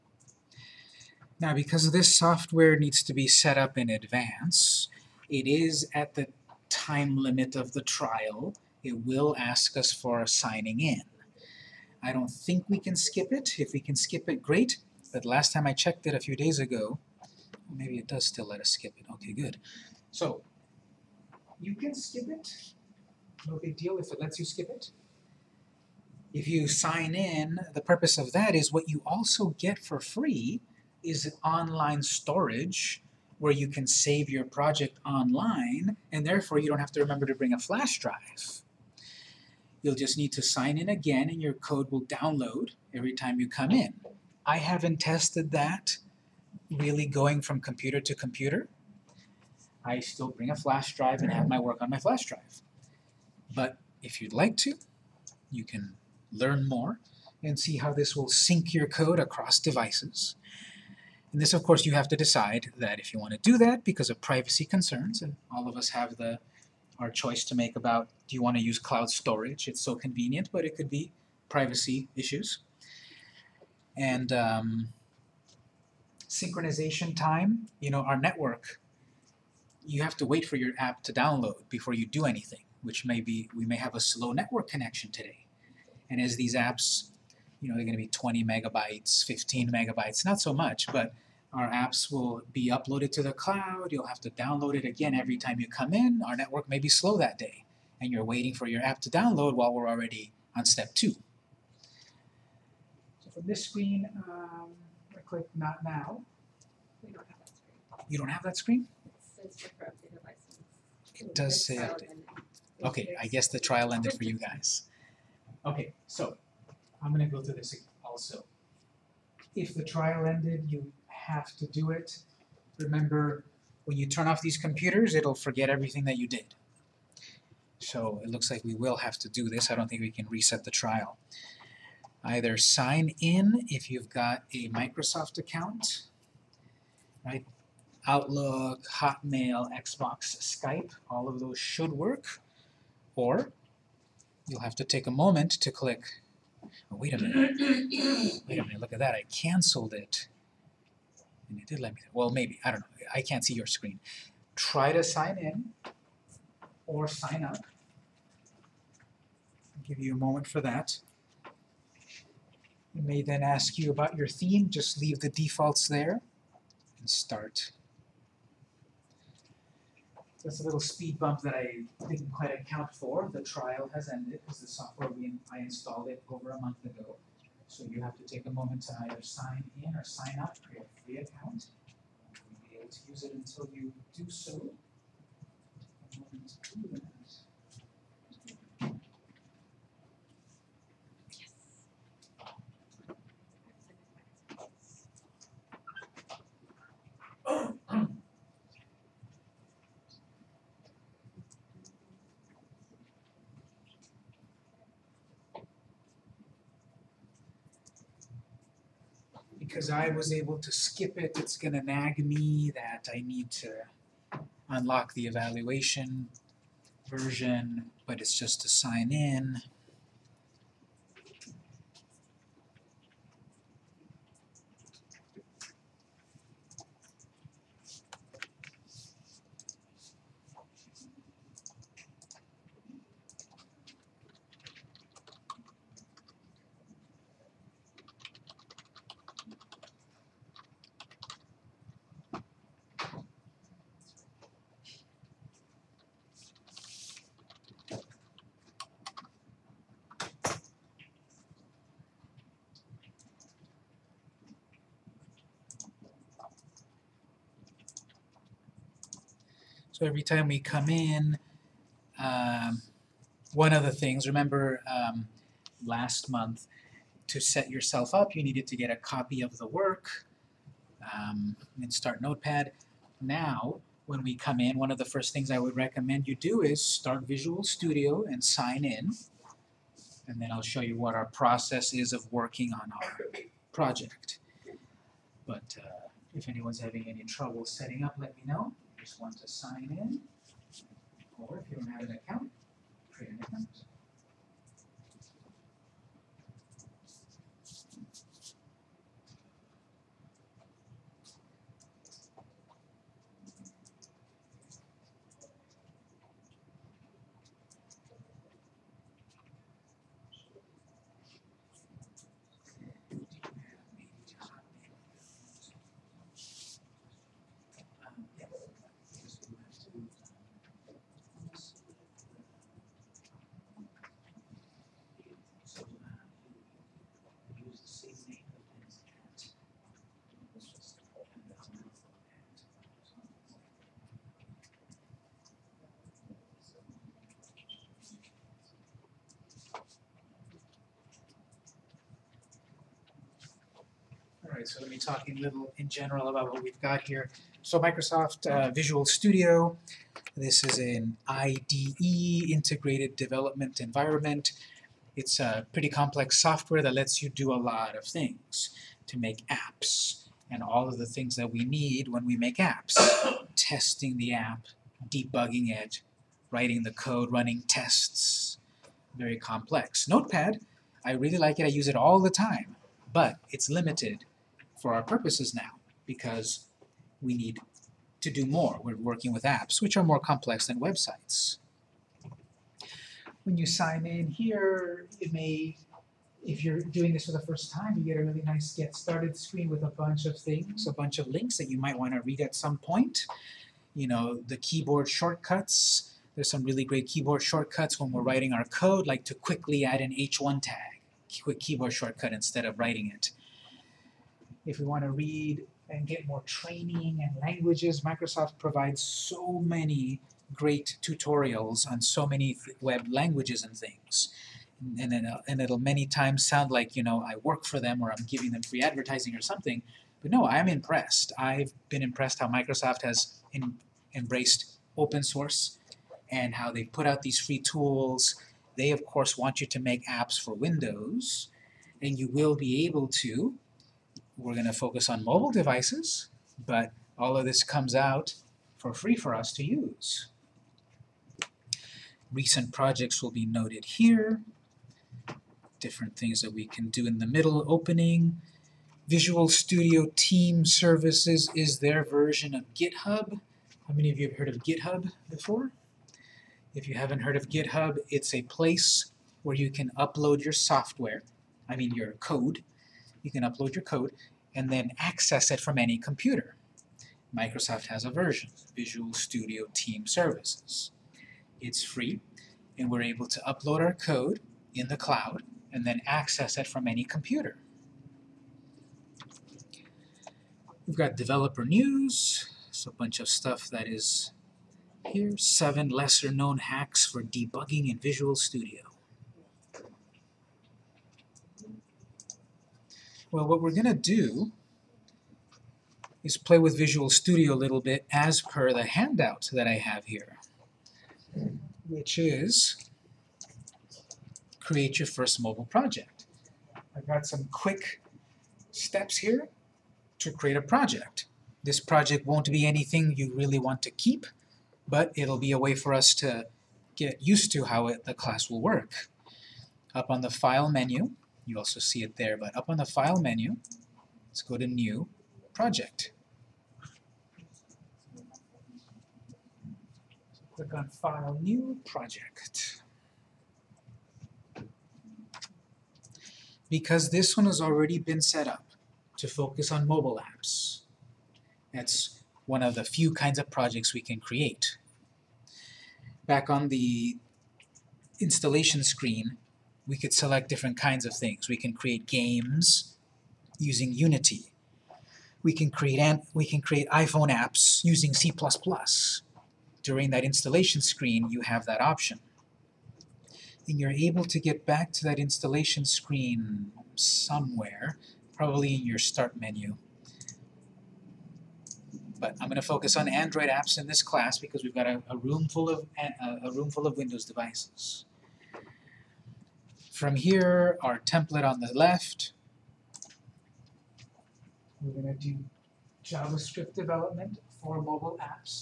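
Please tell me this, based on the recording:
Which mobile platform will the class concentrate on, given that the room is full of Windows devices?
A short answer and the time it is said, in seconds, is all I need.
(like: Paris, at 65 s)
Android, at 573 s.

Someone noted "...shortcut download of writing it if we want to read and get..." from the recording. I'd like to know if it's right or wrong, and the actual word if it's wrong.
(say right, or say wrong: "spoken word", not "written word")
wrong: "instead", not "download".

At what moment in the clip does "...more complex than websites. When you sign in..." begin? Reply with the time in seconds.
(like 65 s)
380 s.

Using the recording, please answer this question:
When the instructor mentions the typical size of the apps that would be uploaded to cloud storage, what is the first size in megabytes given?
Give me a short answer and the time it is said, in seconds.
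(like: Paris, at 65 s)
20 megabytes, at 88 s.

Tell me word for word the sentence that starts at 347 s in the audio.
So Microsoft uh, Visual Studio, this is an IDE, Integrated Development Environment.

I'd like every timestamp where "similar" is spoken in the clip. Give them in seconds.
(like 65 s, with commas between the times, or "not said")
not said.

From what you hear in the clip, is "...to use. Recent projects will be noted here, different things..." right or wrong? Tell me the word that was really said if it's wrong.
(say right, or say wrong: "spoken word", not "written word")
right.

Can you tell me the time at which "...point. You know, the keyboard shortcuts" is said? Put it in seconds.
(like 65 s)
392 s.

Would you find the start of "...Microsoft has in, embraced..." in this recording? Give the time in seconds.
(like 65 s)
422 s.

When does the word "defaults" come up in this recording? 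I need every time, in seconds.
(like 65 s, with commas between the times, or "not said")
165 s.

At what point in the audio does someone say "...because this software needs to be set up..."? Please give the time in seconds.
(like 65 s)
1 s.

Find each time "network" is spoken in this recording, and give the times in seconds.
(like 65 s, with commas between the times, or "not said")
78 s, 84 s, 96 s.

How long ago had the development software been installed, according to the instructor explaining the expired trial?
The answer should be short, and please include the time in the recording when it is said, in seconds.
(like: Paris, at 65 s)
over a month ago, at 176 s.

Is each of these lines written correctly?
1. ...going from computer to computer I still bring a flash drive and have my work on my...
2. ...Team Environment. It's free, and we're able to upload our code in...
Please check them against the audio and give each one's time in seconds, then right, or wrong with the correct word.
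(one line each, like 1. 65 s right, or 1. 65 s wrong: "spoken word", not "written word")
1. 47 s right
2. 469 s wrong: "Services", not "Environment".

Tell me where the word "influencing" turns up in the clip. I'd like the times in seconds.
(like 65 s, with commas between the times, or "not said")
not said.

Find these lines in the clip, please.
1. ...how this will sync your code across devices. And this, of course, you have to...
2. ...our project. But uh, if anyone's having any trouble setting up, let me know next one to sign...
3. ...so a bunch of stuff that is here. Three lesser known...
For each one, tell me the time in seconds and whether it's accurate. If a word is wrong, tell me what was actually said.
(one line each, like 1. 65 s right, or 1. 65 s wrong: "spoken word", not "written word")
1. 57 s right
2. 283 s right
3. 482 s wrong: "Seven", not "Three".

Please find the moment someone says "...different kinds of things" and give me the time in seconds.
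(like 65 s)
550 s.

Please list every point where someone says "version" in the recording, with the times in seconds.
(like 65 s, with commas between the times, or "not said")
217 s, 452 s, 468 s.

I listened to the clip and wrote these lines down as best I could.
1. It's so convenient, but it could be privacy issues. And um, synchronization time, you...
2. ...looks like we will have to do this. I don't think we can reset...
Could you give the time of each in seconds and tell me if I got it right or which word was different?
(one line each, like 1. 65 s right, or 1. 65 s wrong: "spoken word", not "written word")
1. 69 s right
2. 128 s right.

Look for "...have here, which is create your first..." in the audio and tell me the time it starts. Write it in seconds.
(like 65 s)
499 s.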